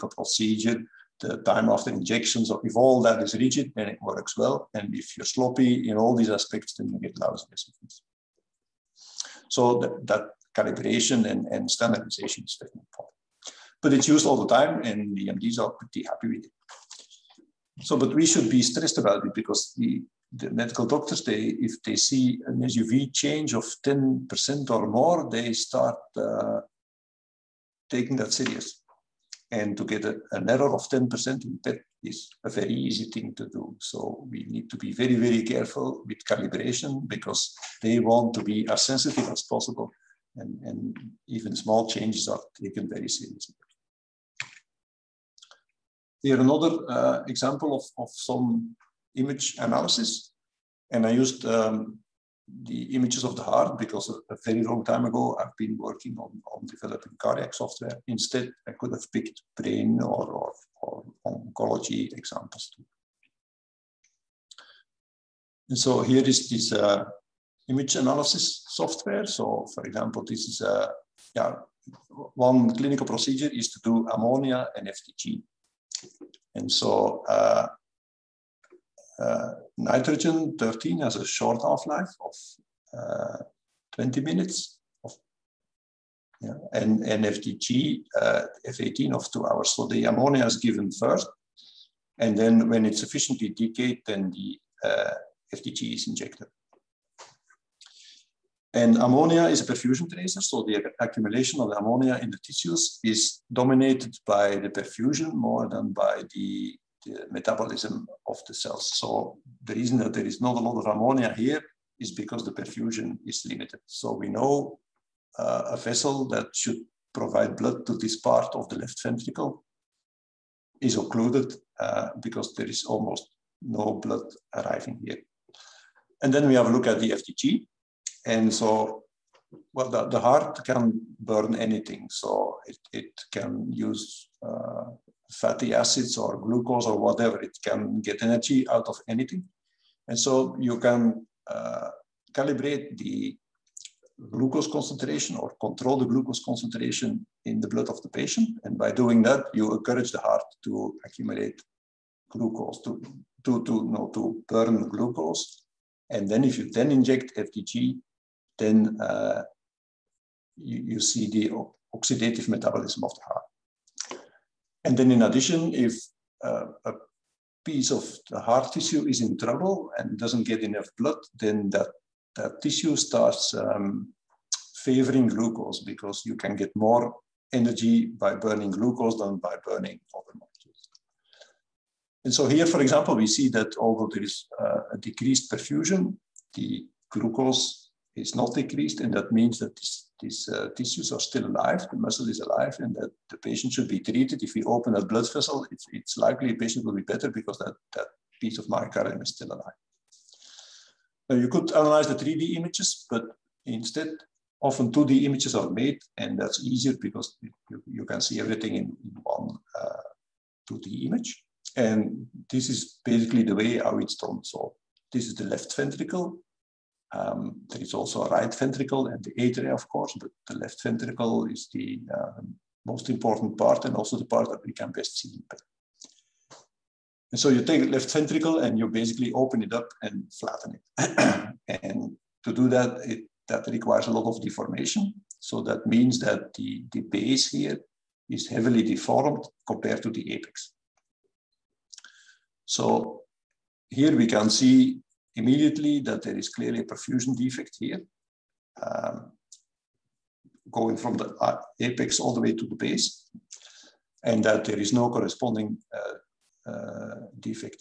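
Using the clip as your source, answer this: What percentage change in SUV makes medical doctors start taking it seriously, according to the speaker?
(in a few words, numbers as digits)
10%.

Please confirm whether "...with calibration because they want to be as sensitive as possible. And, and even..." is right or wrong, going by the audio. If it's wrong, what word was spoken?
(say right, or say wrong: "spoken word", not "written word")
right.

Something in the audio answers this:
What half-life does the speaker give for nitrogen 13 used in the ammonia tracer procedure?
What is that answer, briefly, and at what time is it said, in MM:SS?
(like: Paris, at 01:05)
20 minutes, at 01:23.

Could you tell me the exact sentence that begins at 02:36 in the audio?
And then if you then inject FDG, then uh, you, you see the oxidative metabolism of the heart.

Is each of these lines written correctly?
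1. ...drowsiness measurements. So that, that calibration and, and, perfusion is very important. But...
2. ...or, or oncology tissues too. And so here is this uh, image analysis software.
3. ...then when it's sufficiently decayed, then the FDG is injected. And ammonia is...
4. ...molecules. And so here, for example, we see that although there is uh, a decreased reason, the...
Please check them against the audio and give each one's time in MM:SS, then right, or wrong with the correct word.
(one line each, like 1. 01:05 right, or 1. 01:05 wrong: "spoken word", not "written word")
1. 00:07 wrong: "standardization", not "perfusion"
2. 01:00 wrong: "examples", not "tissues"
3. 01:32 right
4. 03:00 wrong: "perfusion", not "reason".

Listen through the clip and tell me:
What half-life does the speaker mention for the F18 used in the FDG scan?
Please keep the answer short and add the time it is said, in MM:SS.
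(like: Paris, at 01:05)
2 hours, at 01:29.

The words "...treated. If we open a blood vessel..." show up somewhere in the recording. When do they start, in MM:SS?
03:13.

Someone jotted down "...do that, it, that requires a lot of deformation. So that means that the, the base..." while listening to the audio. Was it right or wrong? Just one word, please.
right.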